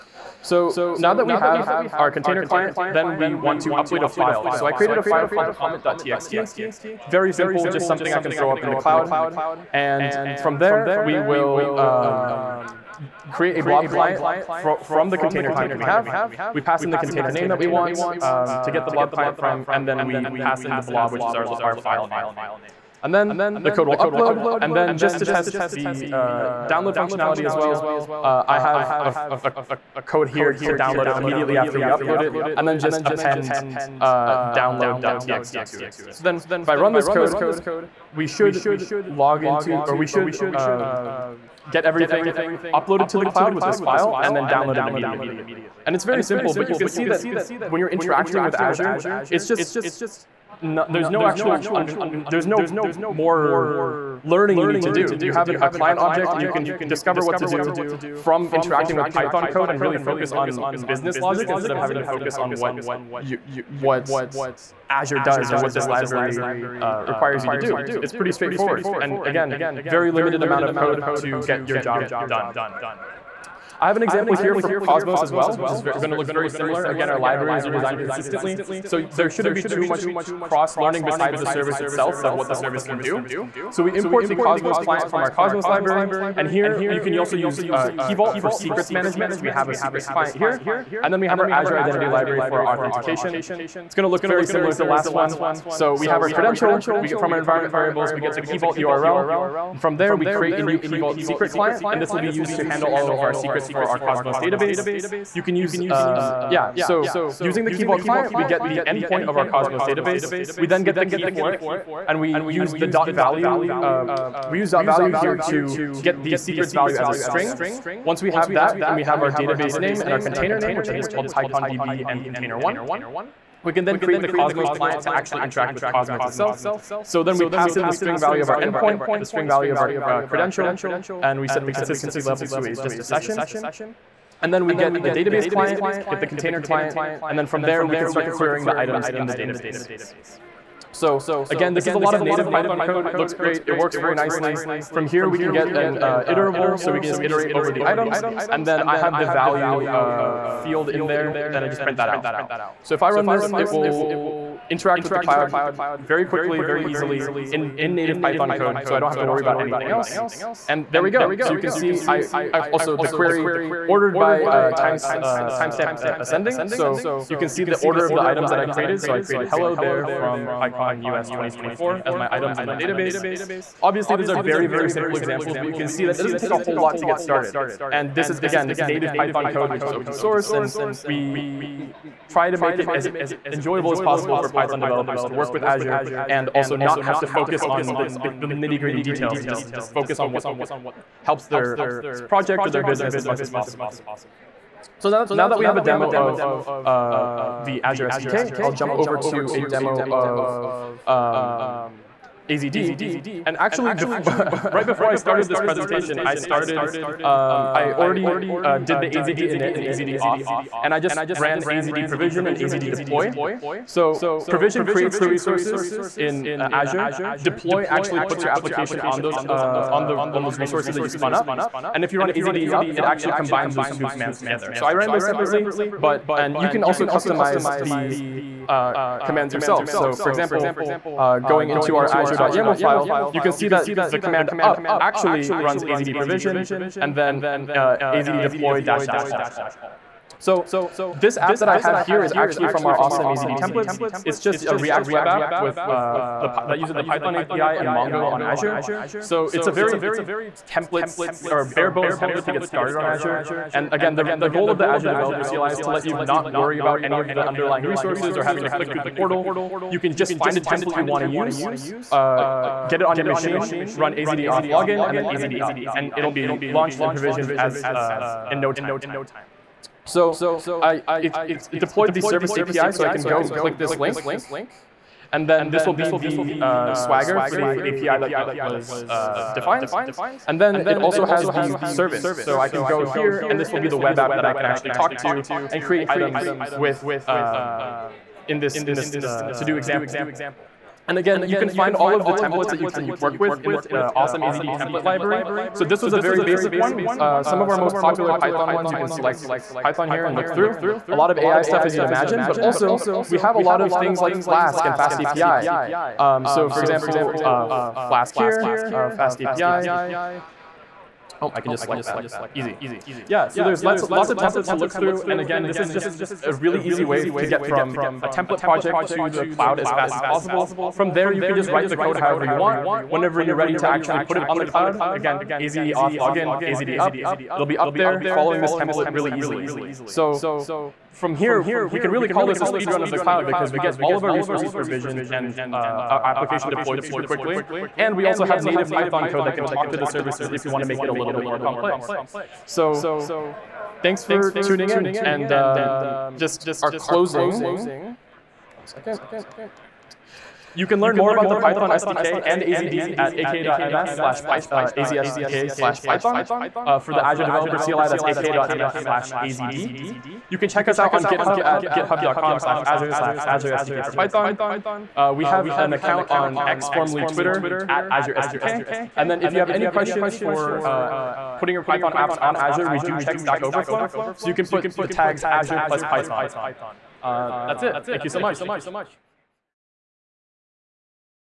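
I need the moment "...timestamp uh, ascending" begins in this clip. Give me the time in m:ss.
2:45.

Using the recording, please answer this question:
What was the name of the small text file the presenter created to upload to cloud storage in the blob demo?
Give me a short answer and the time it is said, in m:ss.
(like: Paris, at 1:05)
comment.txt, at 0:05.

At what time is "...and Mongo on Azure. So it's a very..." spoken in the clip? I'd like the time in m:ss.
4:07.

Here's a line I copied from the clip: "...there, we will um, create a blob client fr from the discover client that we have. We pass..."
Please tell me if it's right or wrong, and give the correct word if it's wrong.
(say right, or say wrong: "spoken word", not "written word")
wrong: "container", not "discover".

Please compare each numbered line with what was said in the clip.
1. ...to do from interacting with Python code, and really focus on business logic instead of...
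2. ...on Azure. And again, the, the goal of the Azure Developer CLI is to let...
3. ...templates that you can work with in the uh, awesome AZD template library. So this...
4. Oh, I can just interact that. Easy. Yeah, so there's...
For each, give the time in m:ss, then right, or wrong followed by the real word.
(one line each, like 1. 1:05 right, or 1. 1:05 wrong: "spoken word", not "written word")
1. 0:57 right
2. 4:12 right
3. 4:52 right
4. 5:11 wrong: "select", not "interact".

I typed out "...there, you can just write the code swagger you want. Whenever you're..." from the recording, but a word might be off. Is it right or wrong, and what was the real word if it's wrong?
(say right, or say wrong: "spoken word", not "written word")
wrong: "however", not "swagger".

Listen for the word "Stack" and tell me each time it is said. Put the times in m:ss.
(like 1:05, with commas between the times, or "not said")
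6:13.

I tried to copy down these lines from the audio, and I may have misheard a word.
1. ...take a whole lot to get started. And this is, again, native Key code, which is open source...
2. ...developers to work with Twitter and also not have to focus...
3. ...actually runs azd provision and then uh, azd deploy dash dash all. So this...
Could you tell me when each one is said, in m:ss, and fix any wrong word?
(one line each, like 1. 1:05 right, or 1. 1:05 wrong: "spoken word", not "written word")
1. 2:56 wrong: "Python", not "Key"
2. 3:04 wrong: "Azure", not "Twitter"
3. 3:54 right.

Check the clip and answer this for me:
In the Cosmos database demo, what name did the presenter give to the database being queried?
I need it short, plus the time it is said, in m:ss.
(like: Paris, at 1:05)
PyConDB, at 2:01.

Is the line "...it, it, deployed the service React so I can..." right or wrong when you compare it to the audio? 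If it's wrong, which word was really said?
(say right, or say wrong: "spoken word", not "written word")
wrong: "API", not "React".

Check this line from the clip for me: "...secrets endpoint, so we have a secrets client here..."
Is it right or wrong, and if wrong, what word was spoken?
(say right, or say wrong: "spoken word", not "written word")
wrong: "management", not "endpoint".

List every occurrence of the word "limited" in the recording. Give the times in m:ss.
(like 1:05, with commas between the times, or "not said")
1:10.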